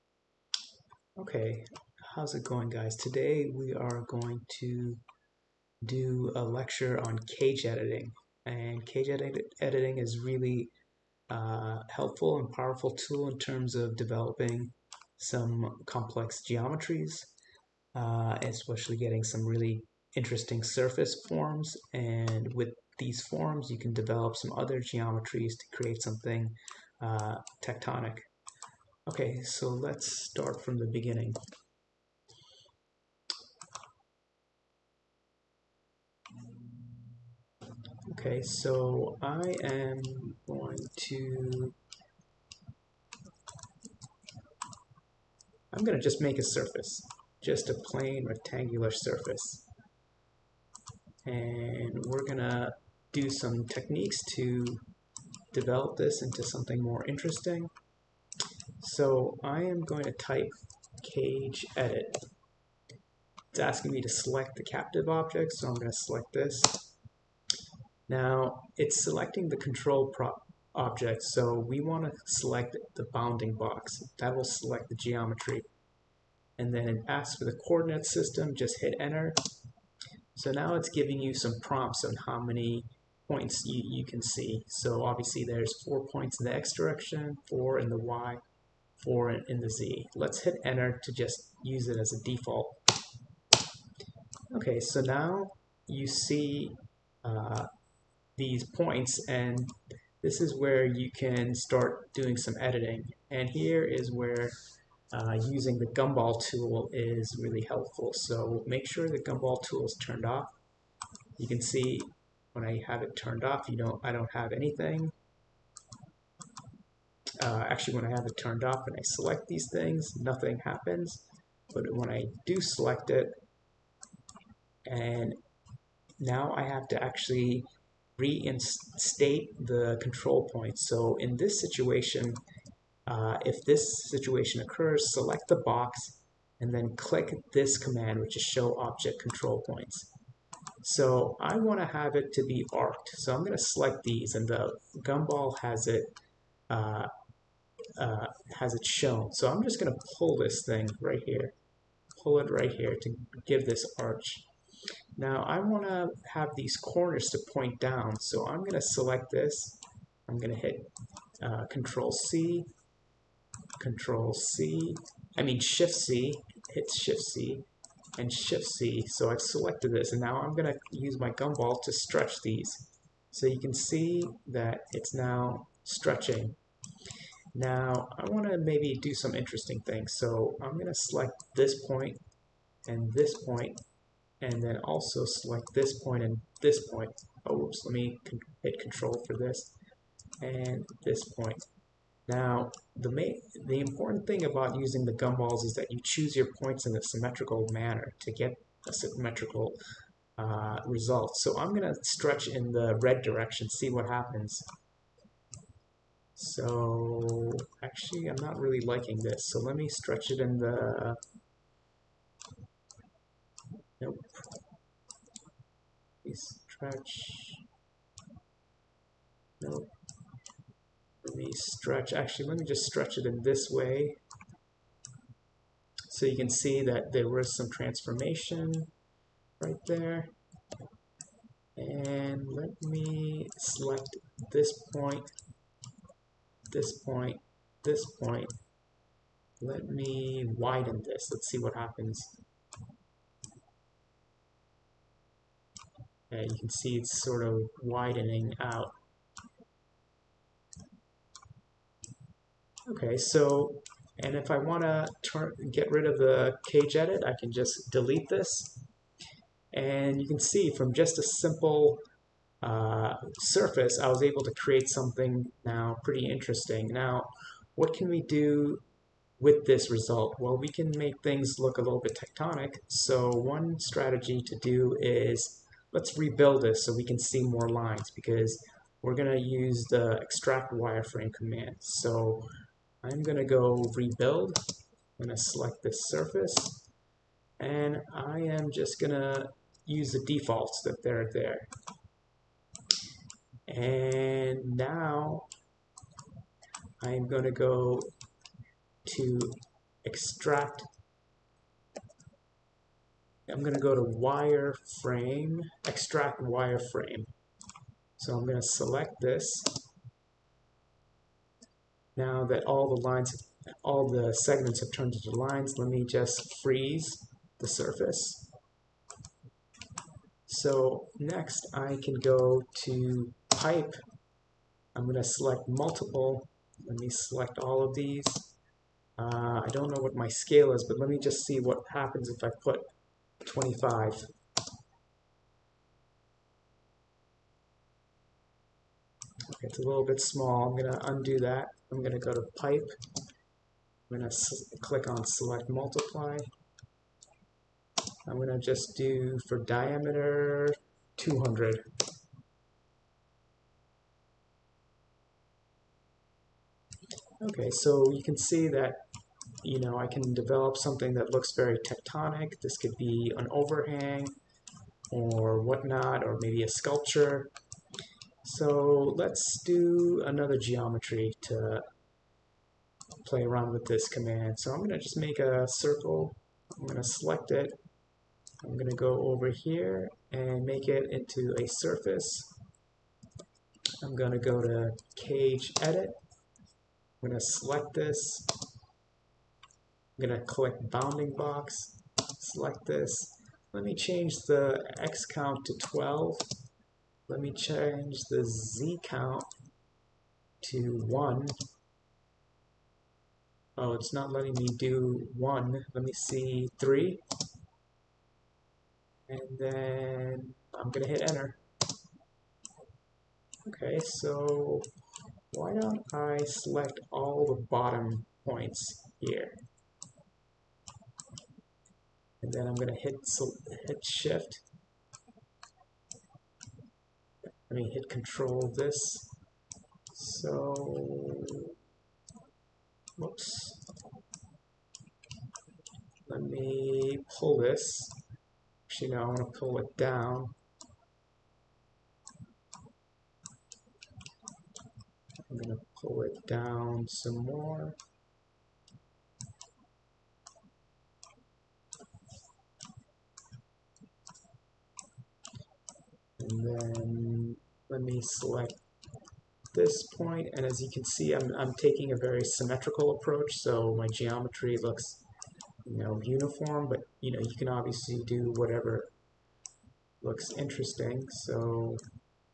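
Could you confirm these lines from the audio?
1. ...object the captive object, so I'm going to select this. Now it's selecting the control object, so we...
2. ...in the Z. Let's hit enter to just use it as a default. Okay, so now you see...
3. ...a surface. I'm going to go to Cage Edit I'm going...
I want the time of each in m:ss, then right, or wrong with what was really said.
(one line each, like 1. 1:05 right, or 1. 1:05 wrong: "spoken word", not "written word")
1. 1:04 wrong: "select", not "object"
2. 1:29 right
3. 6:21 right.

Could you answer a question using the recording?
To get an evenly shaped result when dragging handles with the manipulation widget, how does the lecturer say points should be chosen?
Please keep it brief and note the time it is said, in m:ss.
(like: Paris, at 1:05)
In a symmetrical manner, at 3:16.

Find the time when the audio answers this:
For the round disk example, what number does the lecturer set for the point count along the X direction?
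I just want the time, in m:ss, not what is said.
6:35.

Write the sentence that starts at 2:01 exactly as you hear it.
But when I do select it, and now I have to actually reinstate the control point.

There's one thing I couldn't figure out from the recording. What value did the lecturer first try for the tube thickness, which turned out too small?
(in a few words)
25.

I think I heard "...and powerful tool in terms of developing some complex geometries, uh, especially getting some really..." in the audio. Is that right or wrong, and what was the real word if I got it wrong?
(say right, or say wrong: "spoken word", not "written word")
right.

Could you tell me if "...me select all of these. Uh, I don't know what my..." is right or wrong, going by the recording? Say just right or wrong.
right.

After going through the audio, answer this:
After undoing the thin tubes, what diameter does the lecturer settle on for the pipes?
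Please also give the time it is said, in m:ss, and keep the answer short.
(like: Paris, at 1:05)
200, at 5:51.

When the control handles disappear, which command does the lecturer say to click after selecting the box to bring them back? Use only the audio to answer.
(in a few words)
show object control points.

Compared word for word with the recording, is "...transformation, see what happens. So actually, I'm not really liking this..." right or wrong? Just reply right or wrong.
wrong.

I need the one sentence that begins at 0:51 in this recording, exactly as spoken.
And we're going to do some techniques to develop this into something more interesting.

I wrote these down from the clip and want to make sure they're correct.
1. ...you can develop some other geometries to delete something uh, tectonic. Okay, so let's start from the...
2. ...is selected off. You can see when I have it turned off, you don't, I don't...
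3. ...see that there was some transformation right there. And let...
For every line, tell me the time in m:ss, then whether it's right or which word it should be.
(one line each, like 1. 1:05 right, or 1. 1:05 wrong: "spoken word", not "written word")
1. 0:23 wrong: "create", not "delete"
2. 1:49 wrong: "turned", not "selected"
3. 3:46 right.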